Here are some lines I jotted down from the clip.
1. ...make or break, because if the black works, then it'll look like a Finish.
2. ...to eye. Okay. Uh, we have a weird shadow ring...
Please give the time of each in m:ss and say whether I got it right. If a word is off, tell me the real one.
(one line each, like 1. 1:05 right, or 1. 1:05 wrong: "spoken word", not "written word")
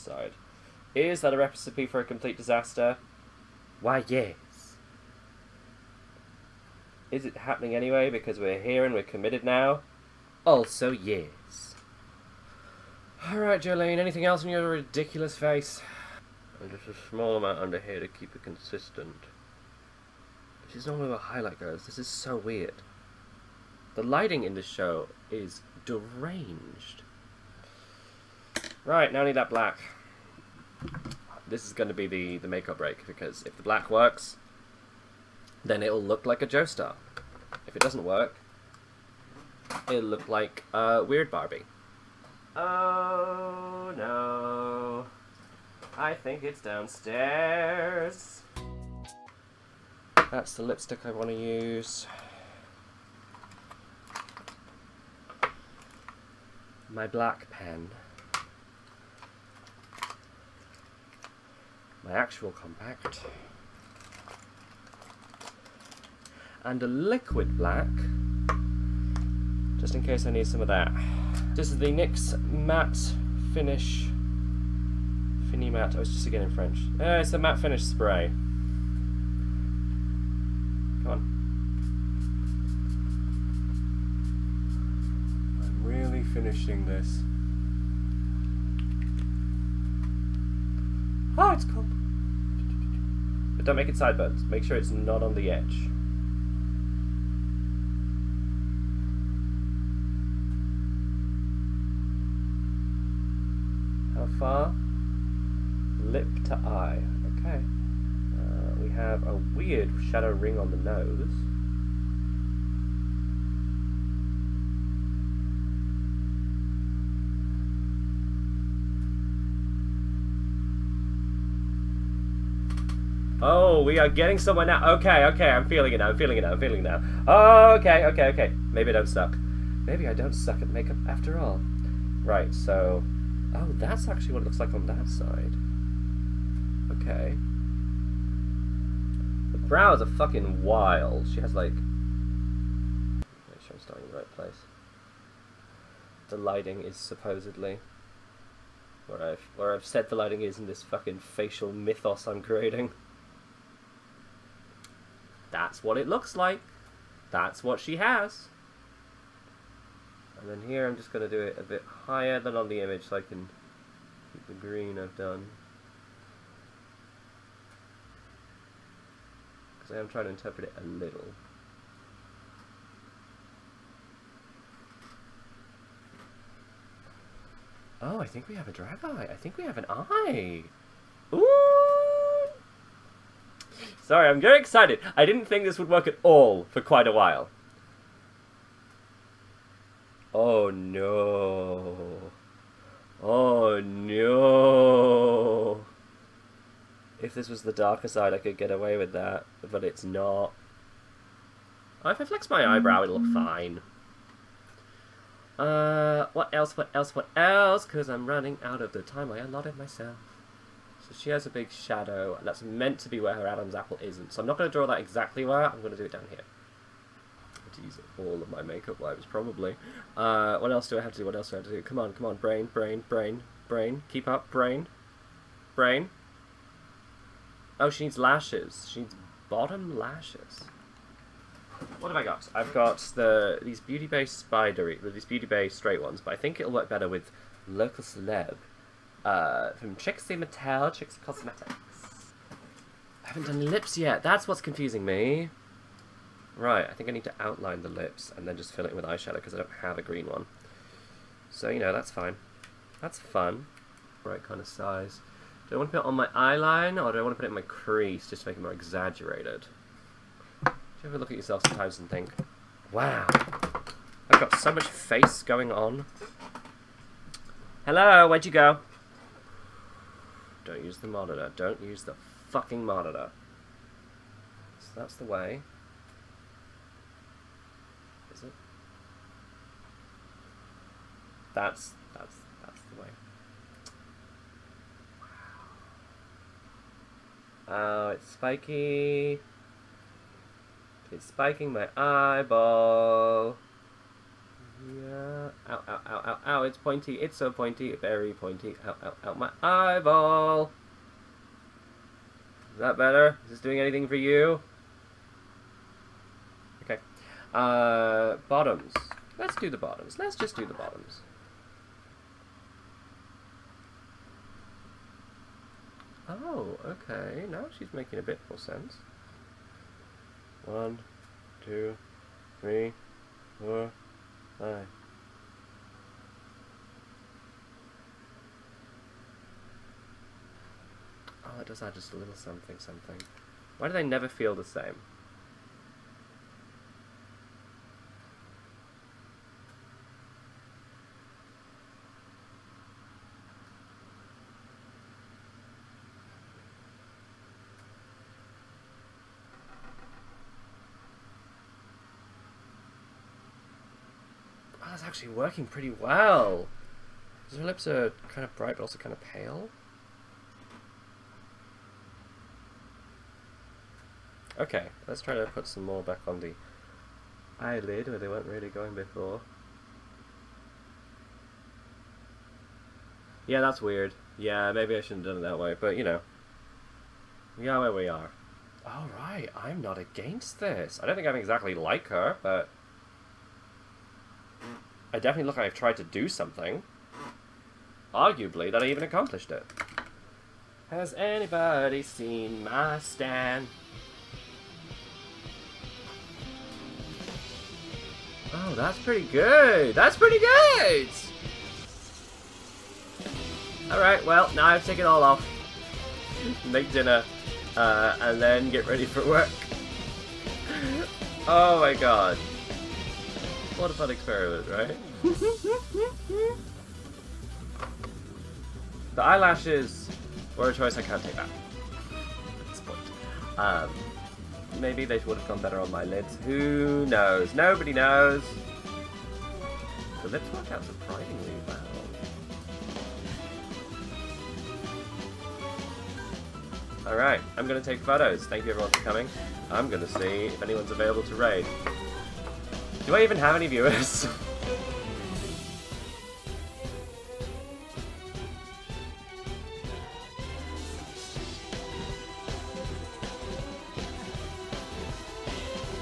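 1. 0:32 wrong: "Joestar", not "Finish"
2. 1:46 right.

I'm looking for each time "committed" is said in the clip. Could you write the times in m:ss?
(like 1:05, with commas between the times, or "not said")
0:09.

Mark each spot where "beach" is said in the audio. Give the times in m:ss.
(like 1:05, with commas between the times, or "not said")
not said.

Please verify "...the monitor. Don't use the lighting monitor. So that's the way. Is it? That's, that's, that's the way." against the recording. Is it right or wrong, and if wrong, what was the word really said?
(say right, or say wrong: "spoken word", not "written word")
wrong: "fucking", not "lighting".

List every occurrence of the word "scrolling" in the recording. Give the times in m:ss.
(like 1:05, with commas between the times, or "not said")
not said.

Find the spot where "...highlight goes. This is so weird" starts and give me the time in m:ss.
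0:21.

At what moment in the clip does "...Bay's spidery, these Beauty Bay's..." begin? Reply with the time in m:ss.
3:54.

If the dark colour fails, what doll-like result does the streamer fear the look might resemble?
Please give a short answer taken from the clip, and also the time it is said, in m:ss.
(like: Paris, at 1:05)
Weird Barbie, at 0:41.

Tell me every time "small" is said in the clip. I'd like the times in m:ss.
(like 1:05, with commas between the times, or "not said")
0:17.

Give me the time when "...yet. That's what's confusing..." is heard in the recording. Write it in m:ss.
4:03.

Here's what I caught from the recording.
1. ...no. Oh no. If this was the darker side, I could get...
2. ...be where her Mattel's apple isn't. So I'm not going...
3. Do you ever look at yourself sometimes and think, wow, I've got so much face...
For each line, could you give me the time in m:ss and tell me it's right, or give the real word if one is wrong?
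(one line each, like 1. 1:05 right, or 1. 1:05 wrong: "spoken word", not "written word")
1. 3:10 right
2. 3:33 wrong: "Adam", not "Mattel"
3. 4:20 right.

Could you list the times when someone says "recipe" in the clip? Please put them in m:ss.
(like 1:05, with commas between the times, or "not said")
0:01.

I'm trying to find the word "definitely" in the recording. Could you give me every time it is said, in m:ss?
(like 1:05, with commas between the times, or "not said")
6:25.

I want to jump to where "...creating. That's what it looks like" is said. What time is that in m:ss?
2:32.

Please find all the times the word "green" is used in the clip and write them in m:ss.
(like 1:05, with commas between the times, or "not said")
2:44, 4:10.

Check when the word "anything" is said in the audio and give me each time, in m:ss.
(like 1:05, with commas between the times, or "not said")
0:13, 5:03.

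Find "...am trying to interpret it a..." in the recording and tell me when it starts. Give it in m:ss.
2:49.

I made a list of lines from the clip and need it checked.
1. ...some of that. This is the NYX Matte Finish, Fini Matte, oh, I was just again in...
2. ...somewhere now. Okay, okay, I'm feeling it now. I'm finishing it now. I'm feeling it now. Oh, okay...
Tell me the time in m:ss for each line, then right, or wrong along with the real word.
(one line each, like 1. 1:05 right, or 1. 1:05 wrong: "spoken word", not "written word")
1. 1:10 right
2. 2:04 wrong: "feeling", not "finishing".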